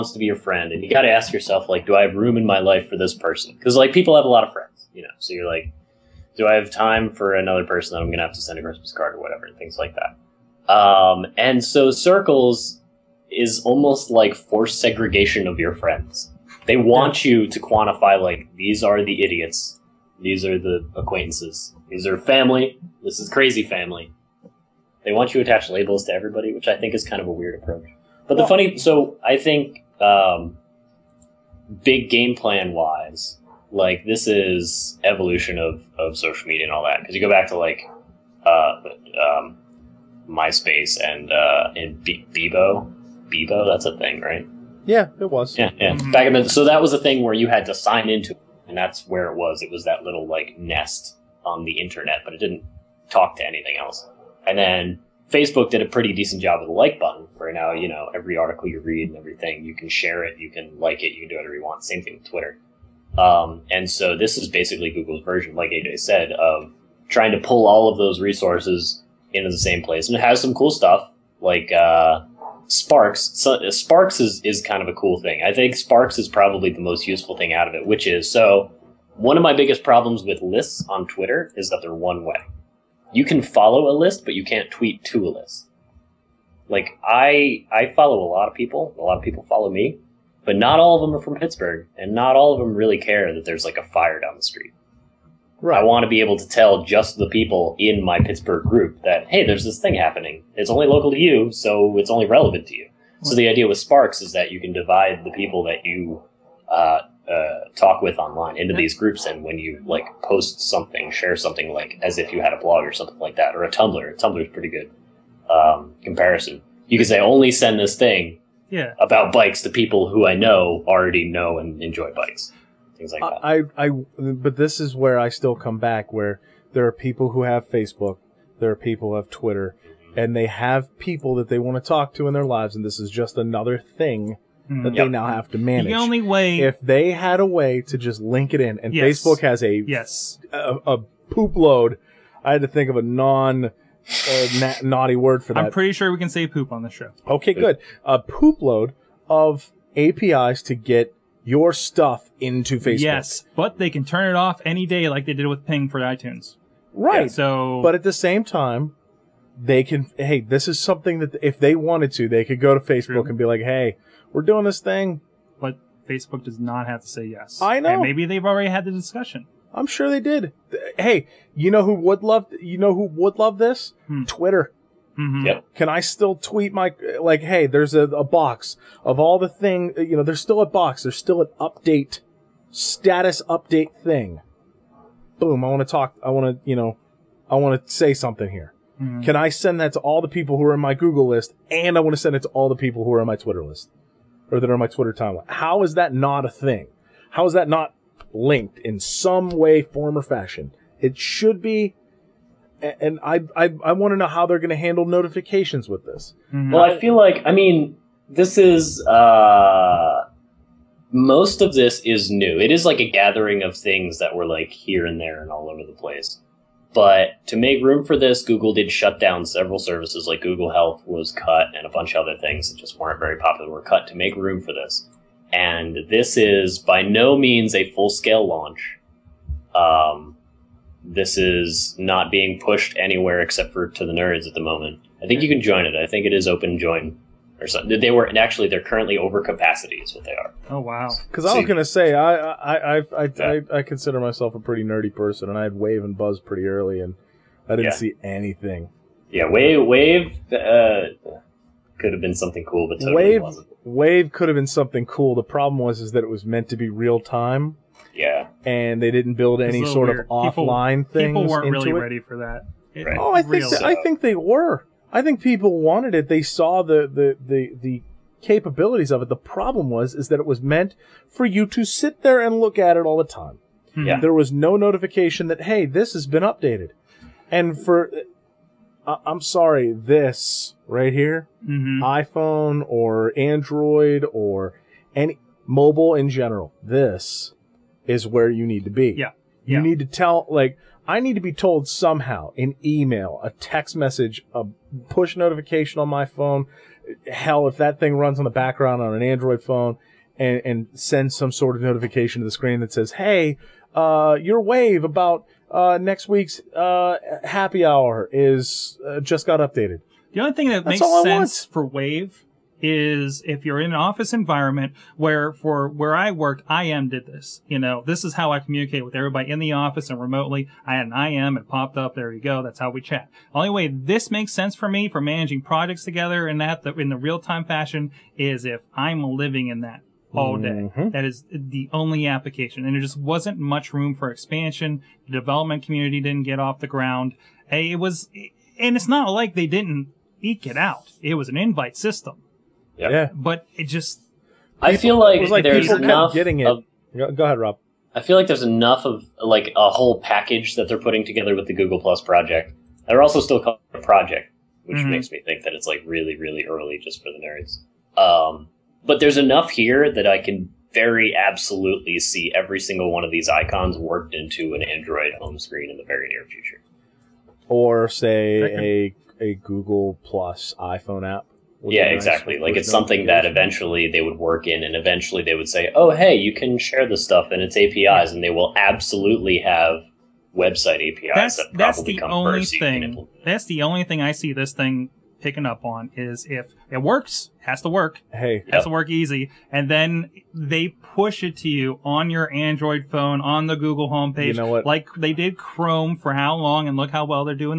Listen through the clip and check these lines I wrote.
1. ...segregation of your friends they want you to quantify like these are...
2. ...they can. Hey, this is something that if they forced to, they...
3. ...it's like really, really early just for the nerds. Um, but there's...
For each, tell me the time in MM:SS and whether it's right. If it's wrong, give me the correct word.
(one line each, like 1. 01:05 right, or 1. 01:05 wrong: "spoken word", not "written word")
1. 00:14 right
2. 02:39 wrong: "wanted", not "forced"
3. 05:55 right.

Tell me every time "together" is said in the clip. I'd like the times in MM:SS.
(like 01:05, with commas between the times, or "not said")
05:26, 05:51.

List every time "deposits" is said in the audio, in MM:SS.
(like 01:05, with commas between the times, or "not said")
not said.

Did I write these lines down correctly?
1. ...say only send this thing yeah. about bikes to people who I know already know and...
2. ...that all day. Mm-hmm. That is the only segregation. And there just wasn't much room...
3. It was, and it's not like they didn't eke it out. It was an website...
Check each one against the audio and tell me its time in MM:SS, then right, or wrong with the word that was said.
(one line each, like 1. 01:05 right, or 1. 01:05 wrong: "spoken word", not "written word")
1. 01:57 right
2. 05:29 wrong: "application", not "segregation"
3. 05:37 wrong: "invite", not "website".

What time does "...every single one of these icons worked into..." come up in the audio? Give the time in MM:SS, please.
06:02.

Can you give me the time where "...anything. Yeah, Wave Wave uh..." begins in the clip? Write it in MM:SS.
04:08.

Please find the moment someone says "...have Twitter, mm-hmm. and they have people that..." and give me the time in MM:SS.
02:09.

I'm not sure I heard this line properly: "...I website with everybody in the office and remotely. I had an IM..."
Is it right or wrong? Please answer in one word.
wrong.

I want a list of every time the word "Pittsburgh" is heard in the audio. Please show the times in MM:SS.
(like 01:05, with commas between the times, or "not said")
01:31, 01:38.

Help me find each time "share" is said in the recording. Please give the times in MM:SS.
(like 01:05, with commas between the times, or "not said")
00:59, 01:51, 06:16.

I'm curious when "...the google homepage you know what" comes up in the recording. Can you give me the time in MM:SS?
06:33.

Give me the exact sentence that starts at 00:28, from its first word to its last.
But the funny, so I think um, big game plan wise, like this is evolution of, of social media and all that.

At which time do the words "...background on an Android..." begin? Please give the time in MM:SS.
04:58.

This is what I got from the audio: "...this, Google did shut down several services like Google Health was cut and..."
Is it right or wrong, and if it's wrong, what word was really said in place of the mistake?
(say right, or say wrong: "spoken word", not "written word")
right.